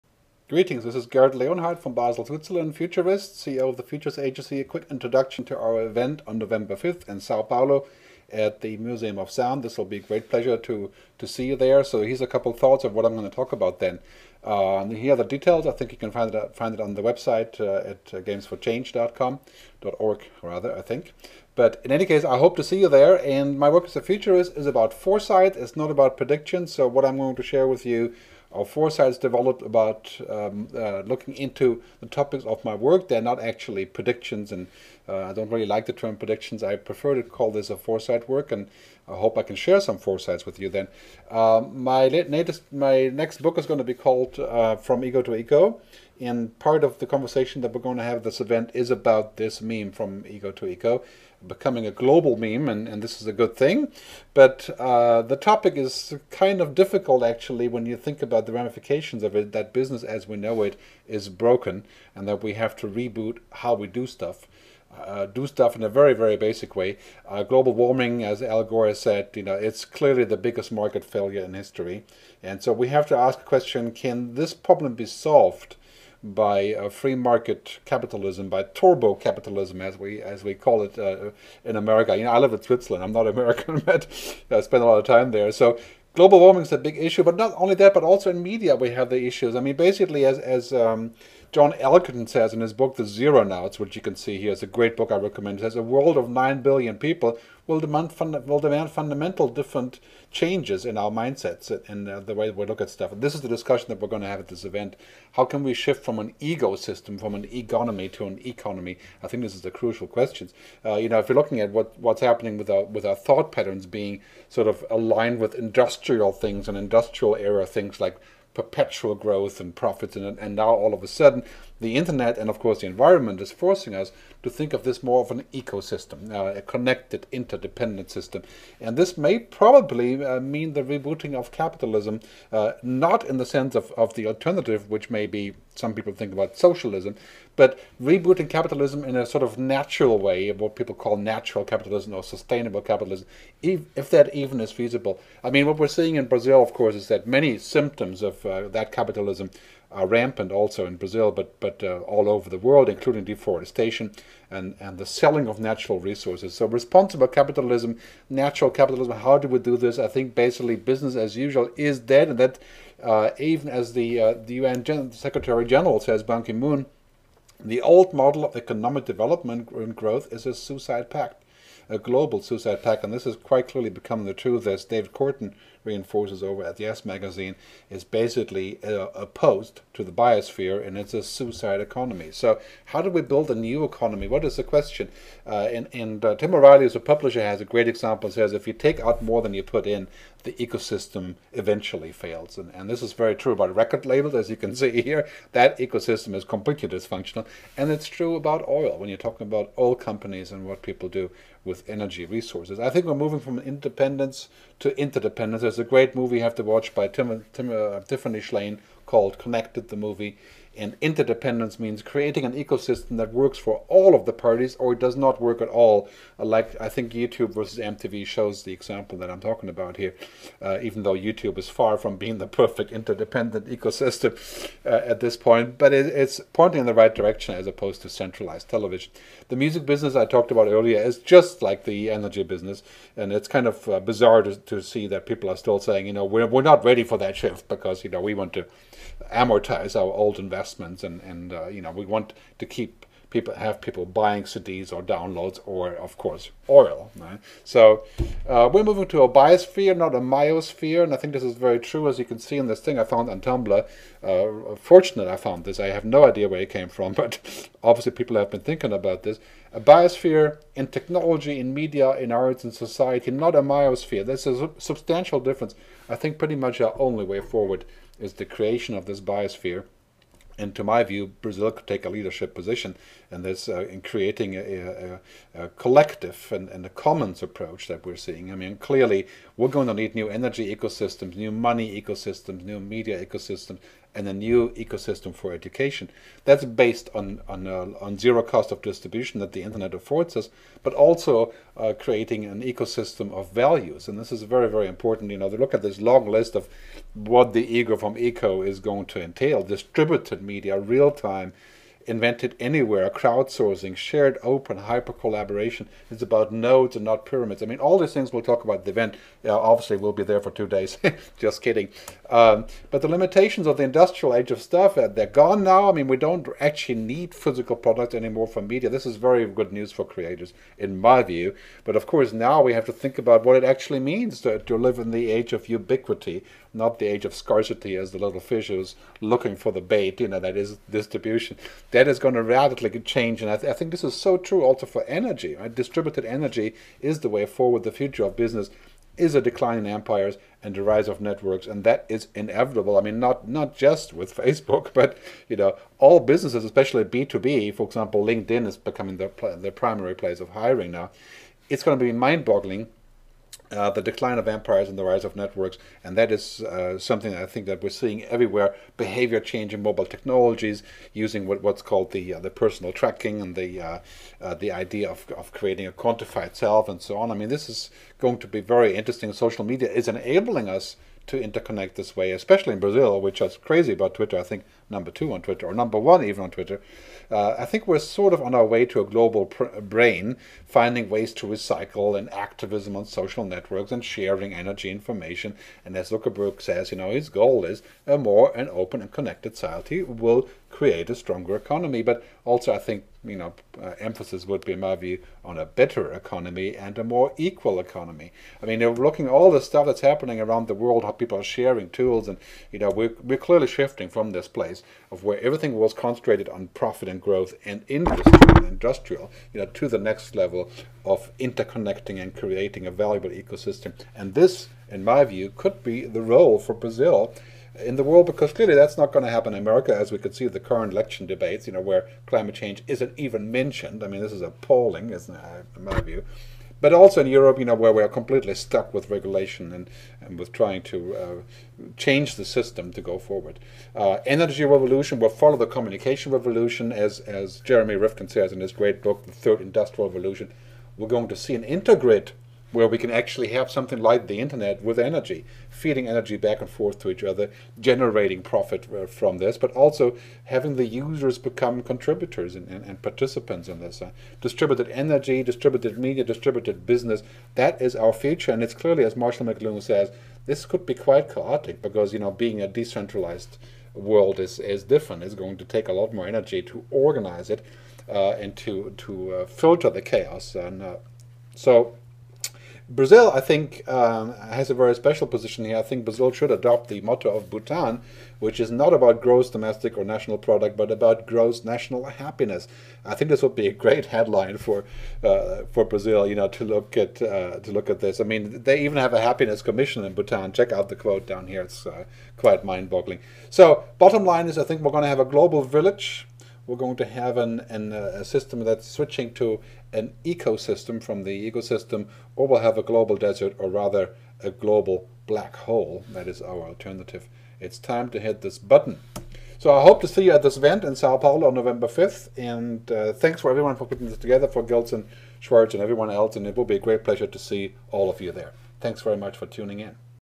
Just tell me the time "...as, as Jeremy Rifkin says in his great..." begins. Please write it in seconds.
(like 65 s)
436 s.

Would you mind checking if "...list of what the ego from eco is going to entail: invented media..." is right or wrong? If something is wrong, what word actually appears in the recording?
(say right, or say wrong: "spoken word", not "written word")
wrong: "distributed", not "invented".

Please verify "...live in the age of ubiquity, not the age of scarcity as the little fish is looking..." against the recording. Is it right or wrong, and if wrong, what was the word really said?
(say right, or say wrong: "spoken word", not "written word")
right.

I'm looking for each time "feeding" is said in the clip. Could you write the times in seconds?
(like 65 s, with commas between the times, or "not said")
445 s.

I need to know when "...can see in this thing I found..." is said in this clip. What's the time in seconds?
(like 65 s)
252 s.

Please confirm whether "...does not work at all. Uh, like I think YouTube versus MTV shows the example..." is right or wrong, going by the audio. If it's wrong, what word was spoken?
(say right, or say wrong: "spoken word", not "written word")
right.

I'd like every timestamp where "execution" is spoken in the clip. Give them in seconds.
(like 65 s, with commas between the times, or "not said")
not said.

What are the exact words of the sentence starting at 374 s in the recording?
I think number two on Twitter, or number one even on Twitter.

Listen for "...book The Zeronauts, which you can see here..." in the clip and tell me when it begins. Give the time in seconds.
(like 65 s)
92 s.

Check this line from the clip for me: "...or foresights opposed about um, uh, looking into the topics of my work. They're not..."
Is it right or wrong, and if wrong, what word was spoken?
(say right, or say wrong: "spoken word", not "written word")
wrong: "developed", not "opposed".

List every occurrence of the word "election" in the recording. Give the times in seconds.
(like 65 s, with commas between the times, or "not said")
420 s.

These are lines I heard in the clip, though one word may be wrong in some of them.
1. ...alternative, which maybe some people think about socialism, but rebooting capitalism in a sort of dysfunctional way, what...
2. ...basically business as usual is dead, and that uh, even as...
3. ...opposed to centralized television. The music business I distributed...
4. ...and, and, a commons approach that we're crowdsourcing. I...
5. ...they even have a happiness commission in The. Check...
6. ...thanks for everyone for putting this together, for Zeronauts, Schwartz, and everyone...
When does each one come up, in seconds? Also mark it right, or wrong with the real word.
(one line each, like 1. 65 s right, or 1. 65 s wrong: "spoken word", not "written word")
1. 134 s wrong: "natural", not "dysfunctional"
2. 160 s right
3. 227 s wrong: "talked", not "distributed"
4. 276 s wrong: "seeing", not "crowdsourcing"
5. 488 s wrong: "Bhutan", not "The"
6. 513 s wrong: "Gilson", not "Zeronauts".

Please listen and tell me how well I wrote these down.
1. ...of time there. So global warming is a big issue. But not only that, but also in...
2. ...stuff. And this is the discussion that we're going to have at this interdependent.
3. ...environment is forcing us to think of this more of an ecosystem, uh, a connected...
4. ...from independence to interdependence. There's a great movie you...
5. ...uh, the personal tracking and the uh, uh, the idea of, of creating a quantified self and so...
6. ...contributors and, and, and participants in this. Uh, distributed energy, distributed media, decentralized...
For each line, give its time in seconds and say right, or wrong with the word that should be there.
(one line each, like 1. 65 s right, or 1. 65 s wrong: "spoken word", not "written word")
1. 84 s right
2. 102 s wrong: "event", not "interdependent"
3. 122 s right
4. 203 s right
5. 362 s right
6. 451 s wrong: "distributed", not "decentralized".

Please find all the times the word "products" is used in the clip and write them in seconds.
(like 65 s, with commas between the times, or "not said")
317 s, 480 s.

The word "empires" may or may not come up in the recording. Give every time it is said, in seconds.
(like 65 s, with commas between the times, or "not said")
339 s, 354 s.